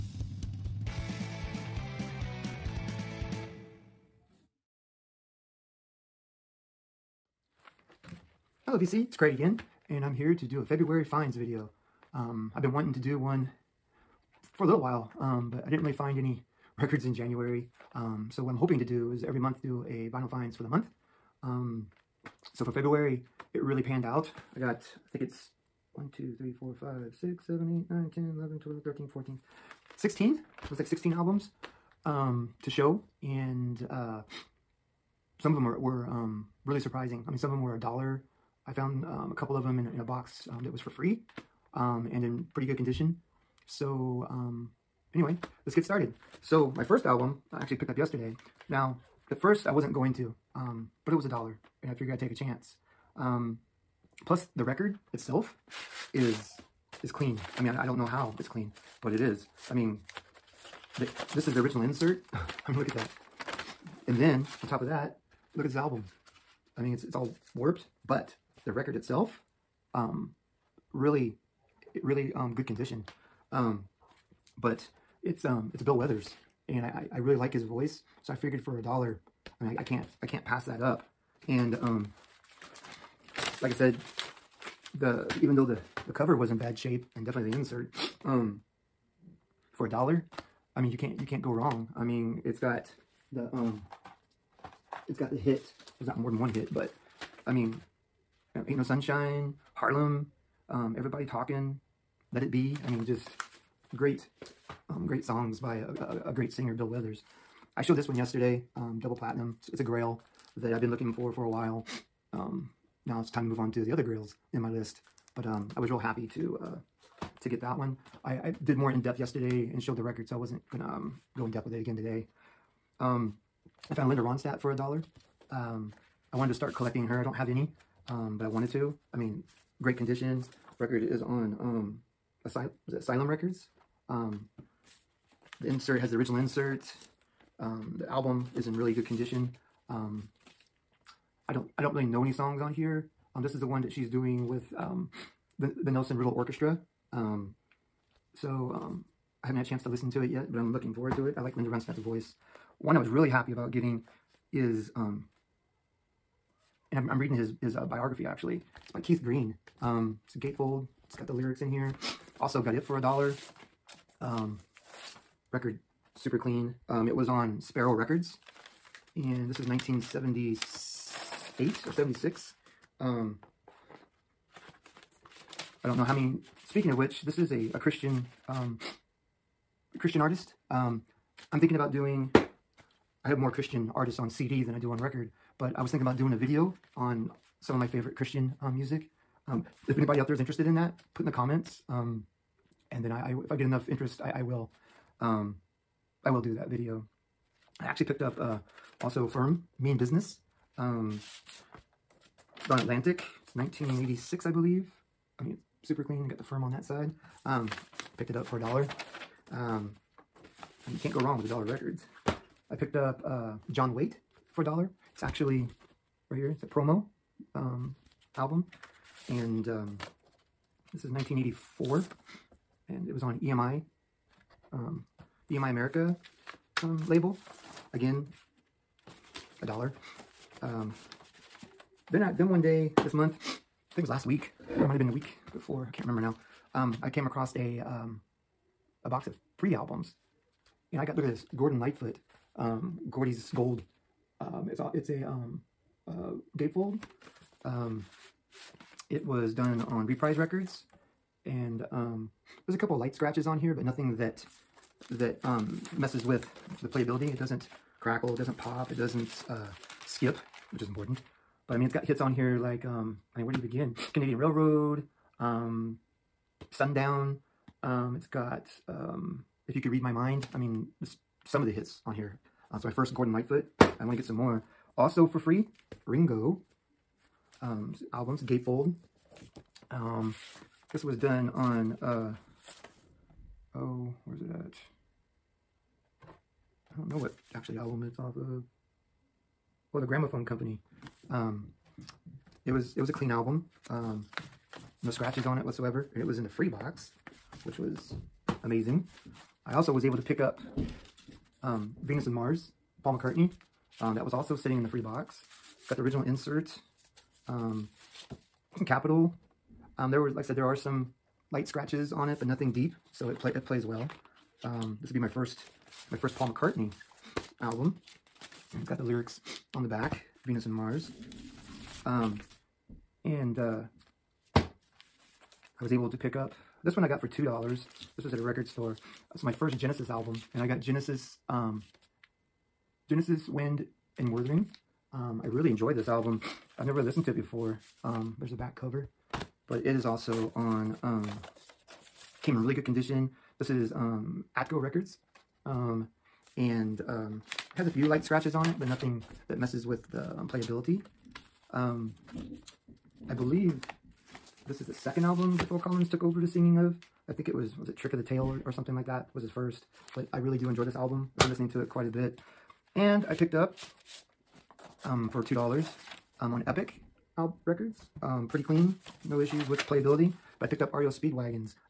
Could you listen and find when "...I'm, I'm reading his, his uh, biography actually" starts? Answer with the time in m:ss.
2:36.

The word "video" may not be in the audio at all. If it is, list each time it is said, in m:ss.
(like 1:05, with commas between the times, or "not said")
0:11, 3:06, 3:16.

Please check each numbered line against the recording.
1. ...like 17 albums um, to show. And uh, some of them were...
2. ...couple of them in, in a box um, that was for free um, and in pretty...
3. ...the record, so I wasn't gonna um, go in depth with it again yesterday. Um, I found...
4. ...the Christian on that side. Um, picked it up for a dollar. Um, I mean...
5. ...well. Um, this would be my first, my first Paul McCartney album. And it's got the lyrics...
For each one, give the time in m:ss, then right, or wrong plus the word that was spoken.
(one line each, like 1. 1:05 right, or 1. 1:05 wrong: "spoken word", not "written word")
1. 0:30 wrong: "16", not "17"
2. 0:39 right
3. 1:59 wrong: "today", not "yesterday"
4. 3:26 wrong: "Firm", not "Christian"
5. 5:13 right.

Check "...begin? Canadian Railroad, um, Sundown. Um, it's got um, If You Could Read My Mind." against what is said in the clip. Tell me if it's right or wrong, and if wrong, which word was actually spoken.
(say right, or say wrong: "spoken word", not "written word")
right.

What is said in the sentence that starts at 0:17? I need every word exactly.
Um, so what I'm hoping to do is every month do a vinyl finds for the month.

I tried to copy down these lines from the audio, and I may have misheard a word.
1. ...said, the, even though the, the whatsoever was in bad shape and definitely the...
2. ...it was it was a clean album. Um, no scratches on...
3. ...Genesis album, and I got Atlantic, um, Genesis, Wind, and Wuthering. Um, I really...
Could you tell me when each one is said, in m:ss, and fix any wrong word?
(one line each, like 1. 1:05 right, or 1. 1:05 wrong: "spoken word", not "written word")
1. 1:23 wrong: "cover", not "whatsoever"
2. 4:52 right
3. 5:29 wrong: "Genesis", not "Atlantic".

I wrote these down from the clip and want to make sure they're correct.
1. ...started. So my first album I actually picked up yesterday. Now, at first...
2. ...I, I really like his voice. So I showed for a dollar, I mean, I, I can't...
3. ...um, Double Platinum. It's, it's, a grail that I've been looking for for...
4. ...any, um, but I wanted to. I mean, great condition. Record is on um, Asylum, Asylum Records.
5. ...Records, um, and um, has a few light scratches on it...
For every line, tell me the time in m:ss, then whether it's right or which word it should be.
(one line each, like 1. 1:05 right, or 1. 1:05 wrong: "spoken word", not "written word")
1. 0:45 right
2. 1:17 wrong: "figured", not "showed"
3. 1:48 right
4. 2:07 right
5. 5:44 right.